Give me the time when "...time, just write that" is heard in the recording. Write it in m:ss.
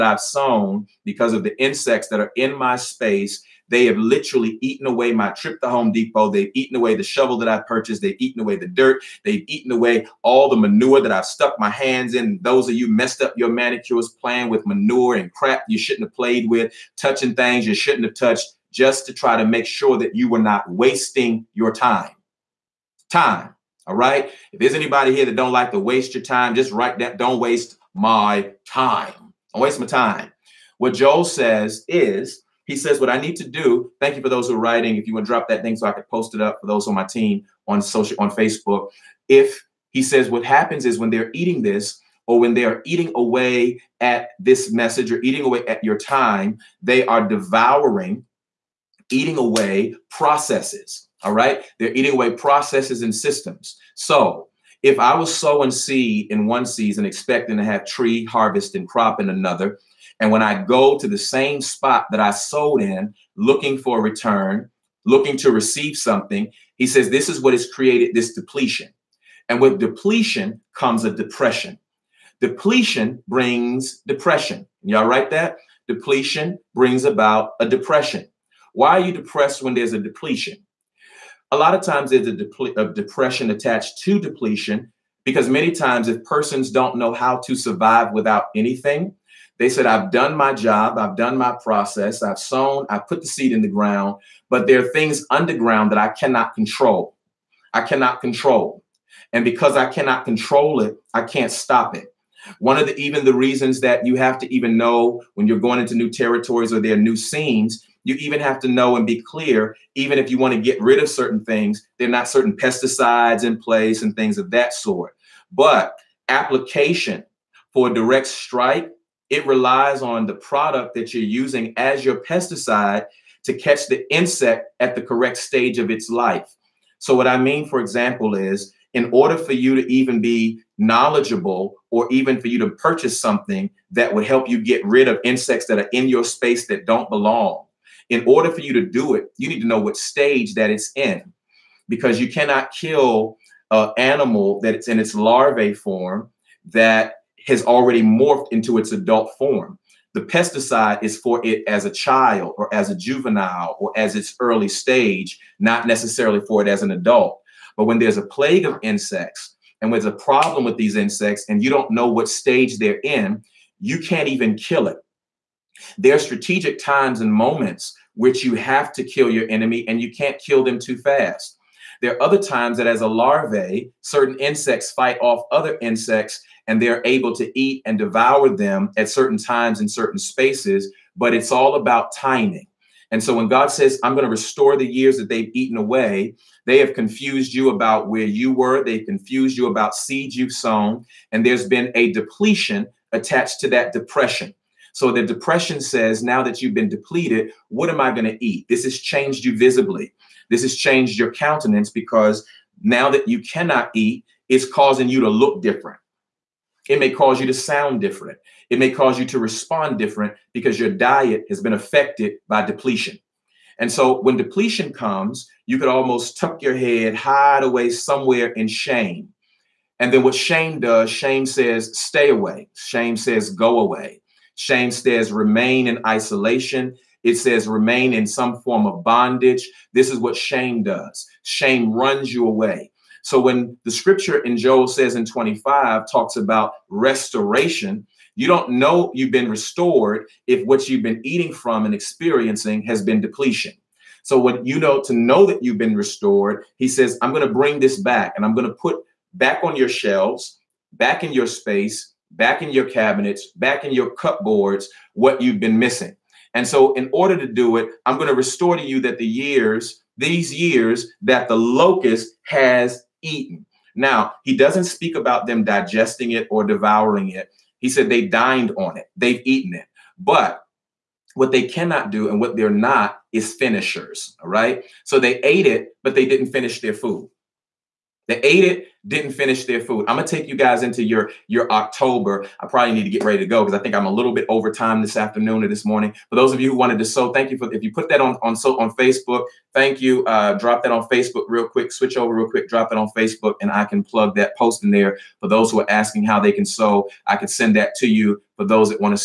0:26.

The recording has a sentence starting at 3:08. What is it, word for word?
They've confused you about seeds you've sown.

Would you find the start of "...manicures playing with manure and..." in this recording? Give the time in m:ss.
0:13.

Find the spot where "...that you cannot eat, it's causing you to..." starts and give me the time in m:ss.
3:23.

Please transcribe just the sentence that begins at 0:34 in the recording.
If you would drop that thing so I could post it up for those on my team on social on Facebook.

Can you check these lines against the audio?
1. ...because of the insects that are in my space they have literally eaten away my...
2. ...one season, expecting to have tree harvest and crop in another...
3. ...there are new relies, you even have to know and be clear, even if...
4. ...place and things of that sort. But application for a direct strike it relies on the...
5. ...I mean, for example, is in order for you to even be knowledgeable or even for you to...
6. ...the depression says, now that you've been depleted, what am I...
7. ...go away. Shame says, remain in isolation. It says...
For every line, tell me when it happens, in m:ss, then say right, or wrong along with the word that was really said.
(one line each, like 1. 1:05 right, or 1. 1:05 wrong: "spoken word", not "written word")
1. 0:01 right
2. 0:56 right
3. 1:46 wrong: "scenes", not "relies"
4. 1:53 right
5. 2:07 right
6. 3:15 right
7. 3:43 right.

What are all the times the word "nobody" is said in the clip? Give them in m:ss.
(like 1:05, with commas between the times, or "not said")
not said.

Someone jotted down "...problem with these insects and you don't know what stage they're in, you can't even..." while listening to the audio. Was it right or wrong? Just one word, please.
right.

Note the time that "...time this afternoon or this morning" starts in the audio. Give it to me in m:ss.
4:44.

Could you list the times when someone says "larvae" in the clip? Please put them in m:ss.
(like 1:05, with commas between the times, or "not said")
2:25, 2:53.